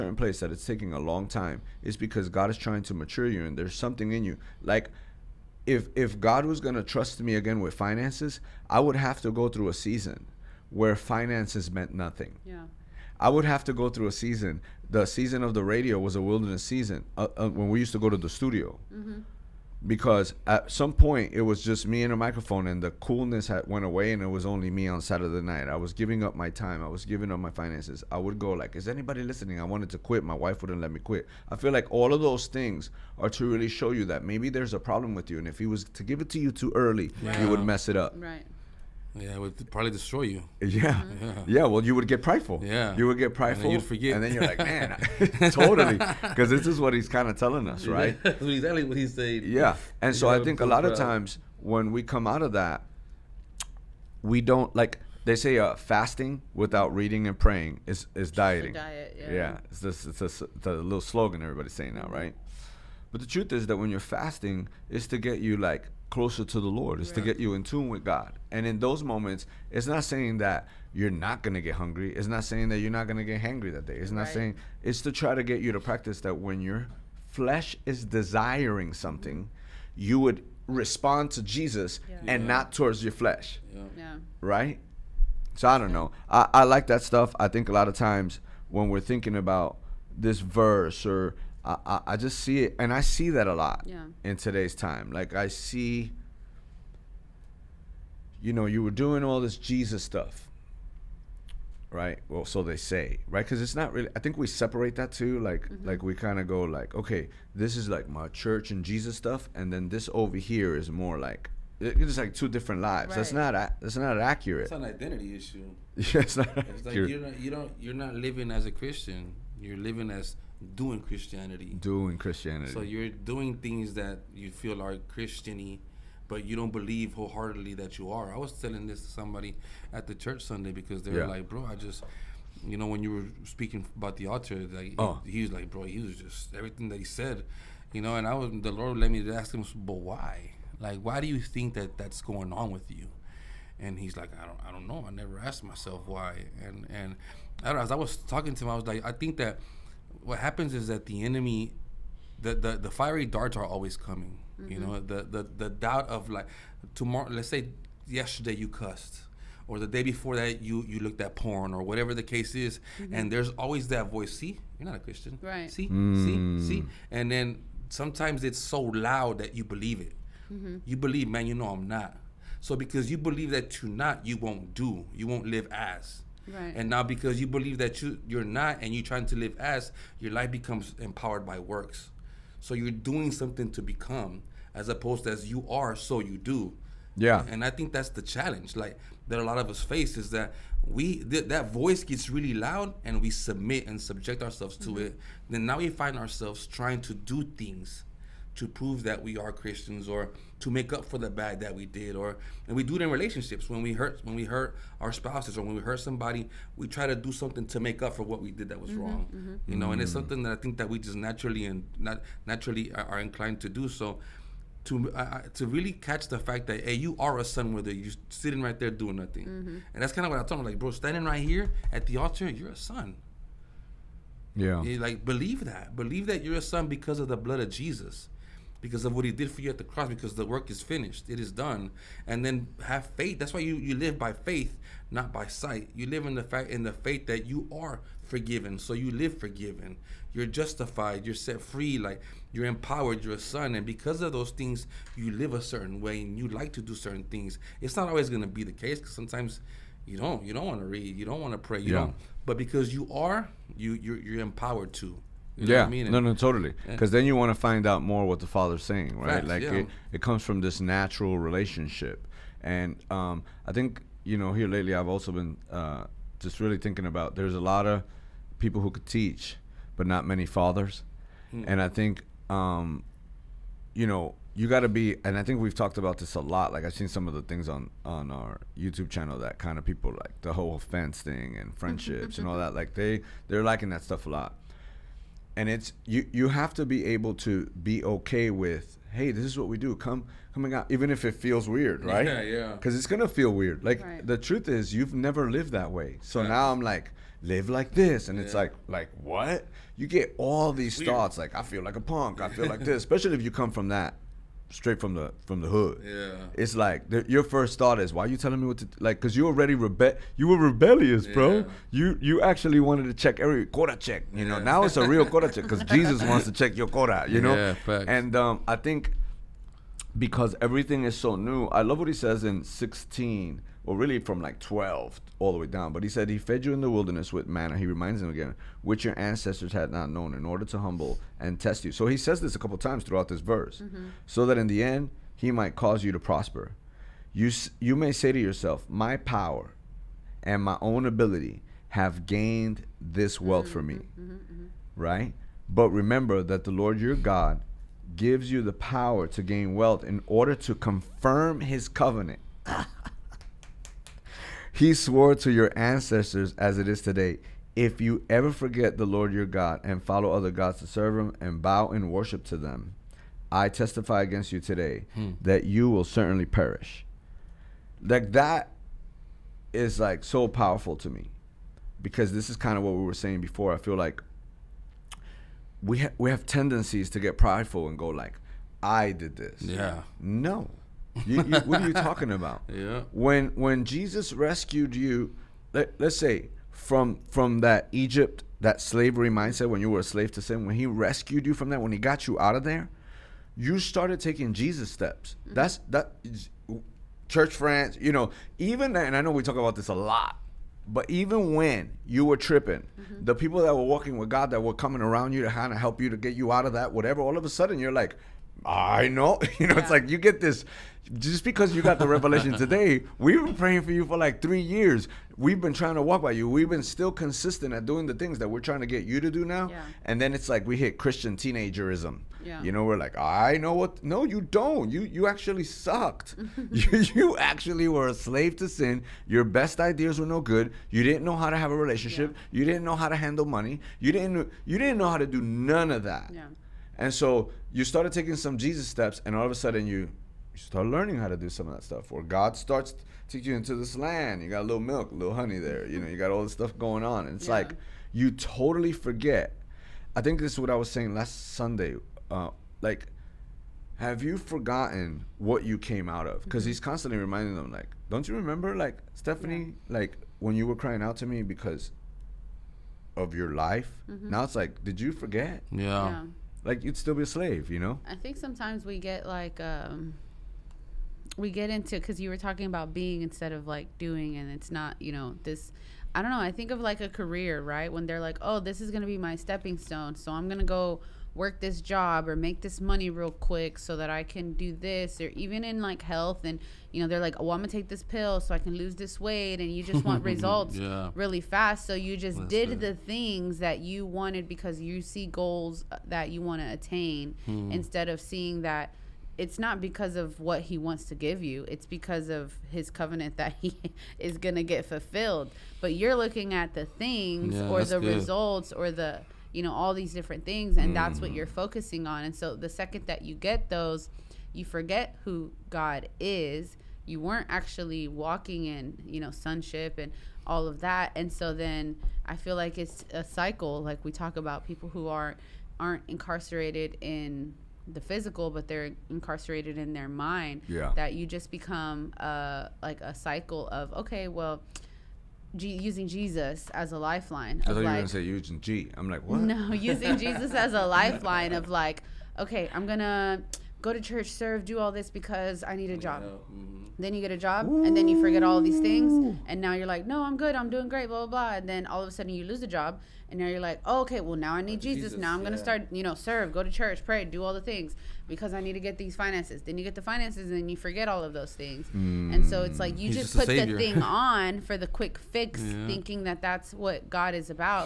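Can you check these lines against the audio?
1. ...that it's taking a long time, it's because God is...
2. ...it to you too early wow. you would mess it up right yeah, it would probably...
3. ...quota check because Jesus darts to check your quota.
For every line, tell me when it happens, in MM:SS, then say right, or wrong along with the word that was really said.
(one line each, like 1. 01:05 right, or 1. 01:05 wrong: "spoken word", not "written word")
1. 00:00 right
2. 00:36 right
3. 05:15 wrong: "wants", not "darts".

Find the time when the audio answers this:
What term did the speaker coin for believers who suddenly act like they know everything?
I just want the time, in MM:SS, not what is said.
07:00.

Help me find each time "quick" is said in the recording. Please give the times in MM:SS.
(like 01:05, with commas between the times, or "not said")
08:03, 09:24.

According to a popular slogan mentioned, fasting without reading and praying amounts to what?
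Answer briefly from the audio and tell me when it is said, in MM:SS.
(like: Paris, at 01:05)
Dieting, at 00:58.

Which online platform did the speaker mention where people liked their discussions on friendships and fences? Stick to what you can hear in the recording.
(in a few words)
YouTube.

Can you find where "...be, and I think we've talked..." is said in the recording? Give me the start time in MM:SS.
04:34.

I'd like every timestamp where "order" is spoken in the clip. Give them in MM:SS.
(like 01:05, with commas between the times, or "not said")
05:30, 05:50.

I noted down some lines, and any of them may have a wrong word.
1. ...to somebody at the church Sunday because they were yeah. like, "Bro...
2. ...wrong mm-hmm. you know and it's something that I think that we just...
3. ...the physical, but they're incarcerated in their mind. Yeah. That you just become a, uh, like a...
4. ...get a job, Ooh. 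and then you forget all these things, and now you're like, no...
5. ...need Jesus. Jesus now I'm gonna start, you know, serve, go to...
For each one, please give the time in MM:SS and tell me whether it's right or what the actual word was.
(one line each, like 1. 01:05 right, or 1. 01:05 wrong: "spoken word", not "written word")
1. 02:09 right
2. 03:29 right
3. 08:47 right
4. 09:07 right
5. 09:14 right.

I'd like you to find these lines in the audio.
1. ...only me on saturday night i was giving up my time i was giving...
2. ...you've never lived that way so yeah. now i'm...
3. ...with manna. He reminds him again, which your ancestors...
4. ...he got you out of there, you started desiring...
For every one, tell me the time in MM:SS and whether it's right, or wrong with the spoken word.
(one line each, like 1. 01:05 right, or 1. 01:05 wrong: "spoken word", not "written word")
1. 00:24 right
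2. 04:54 right
3. 05:27 right
4. 06:31 wrong: "taking", not "desiring".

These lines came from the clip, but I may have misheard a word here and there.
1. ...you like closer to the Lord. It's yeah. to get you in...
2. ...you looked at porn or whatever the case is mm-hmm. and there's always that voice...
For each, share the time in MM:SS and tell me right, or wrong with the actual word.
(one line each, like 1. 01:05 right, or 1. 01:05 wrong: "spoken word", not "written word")
1. 01:05 right
2. 02:40 right.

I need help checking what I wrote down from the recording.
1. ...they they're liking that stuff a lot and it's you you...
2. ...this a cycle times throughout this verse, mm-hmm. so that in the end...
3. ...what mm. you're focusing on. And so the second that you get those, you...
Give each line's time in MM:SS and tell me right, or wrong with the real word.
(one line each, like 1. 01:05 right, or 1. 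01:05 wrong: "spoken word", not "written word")
1. 04:42 right
2. 05:32 wrong: "couple", not "cycle"
3. 08:31 right.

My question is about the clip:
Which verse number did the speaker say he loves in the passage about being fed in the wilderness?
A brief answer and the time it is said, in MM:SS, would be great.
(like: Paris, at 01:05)
16, at 05:22.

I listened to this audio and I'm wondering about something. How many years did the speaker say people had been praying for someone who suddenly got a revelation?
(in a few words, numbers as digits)
3.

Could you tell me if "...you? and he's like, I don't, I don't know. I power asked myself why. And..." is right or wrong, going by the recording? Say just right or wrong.
wrong.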